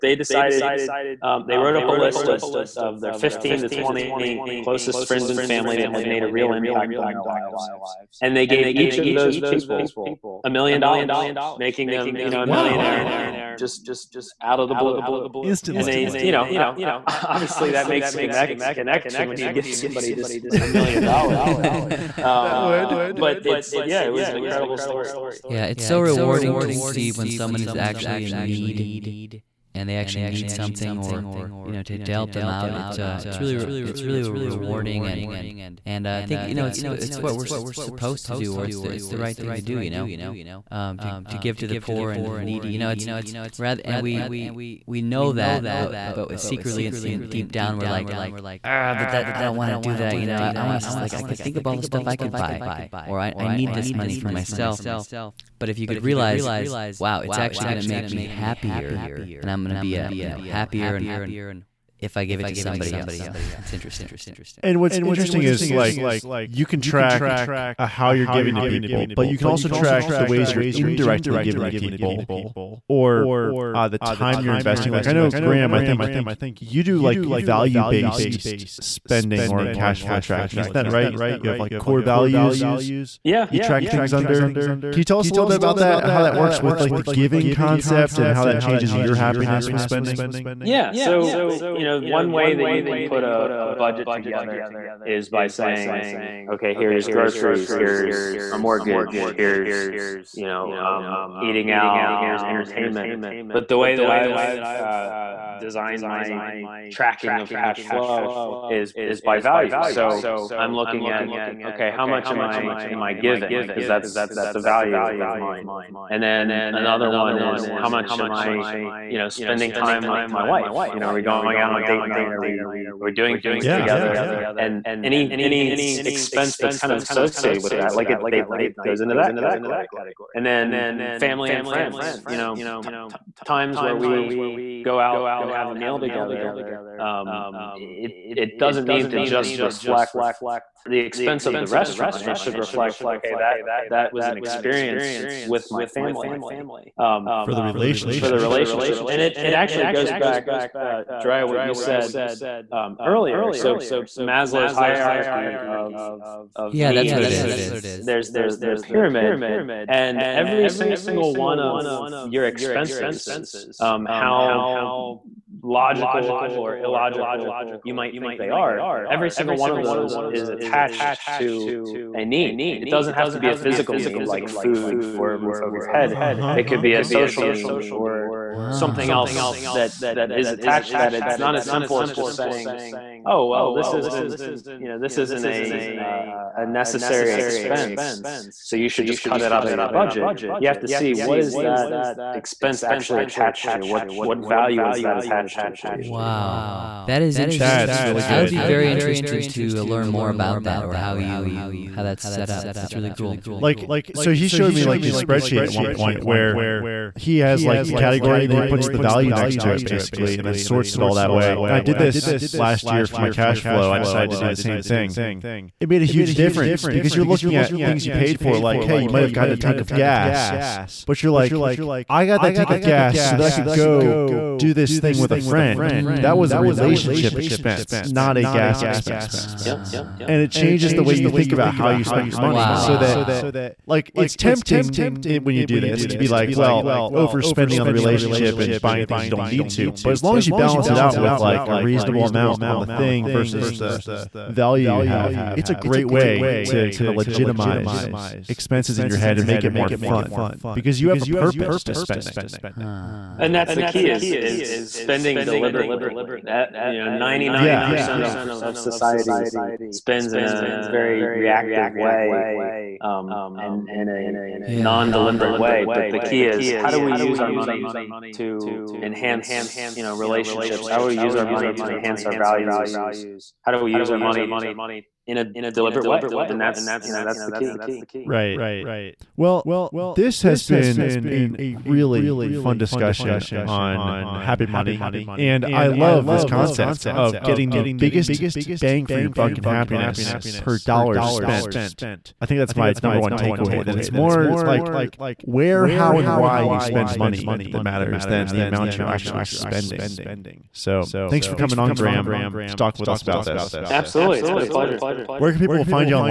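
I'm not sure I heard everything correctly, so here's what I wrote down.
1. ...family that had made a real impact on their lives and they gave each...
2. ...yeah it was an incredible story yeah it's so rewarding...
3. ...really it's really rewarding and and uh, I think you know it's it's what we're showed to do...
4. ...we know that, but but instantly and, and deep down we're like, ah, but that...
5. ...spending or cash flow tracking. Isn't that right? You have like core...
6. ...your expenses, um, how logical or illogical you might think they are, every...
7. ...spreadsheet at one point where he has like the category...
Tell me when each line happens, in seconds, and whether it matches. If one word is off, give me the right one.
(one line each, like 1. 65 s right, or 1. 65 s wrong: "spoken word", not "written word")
1. 5 s right
2. 23 s right
3. 33 s wrong: "supposed", not "showed"
4. 44 s wrong: "secretly", not "instantly"
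5. 78 s right
6. 162 s right
7. 205 s right.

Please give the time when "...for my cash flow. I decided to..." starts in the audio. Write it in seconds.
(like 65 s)
213 s.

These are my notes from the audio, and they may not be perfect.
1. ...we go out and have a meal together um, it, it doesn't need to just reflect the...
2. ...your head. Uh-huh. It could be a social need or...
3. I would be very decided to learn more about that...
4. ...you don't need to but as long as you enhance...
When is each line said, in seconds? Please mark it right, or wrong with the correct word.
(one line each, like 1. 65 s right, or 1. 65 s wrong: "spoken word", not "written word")
1. 133 s right
2. 175 s right
3. 198 s wrong: "interested", not "decided"
4. 239 s wrong: "balance", not "enhance".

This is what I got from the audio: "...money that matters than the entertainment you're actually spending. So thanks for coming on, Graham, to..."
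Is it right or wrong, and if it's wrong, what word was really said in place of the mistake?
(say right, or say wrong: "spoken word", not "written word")
wrong: "amount", not "entertainment".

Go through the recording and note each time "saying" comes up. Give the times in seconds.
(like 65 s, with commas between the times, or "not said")
95 s, 182 s.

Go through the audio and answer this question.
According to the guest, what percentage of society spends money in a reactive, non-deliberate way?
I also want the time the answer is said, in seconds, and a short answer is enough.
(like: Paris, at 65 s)
99%, at 257 s.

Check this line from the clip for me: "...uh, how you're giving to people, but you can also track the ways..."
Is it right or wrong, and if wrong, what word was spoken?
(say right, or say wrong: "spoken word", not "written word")
right.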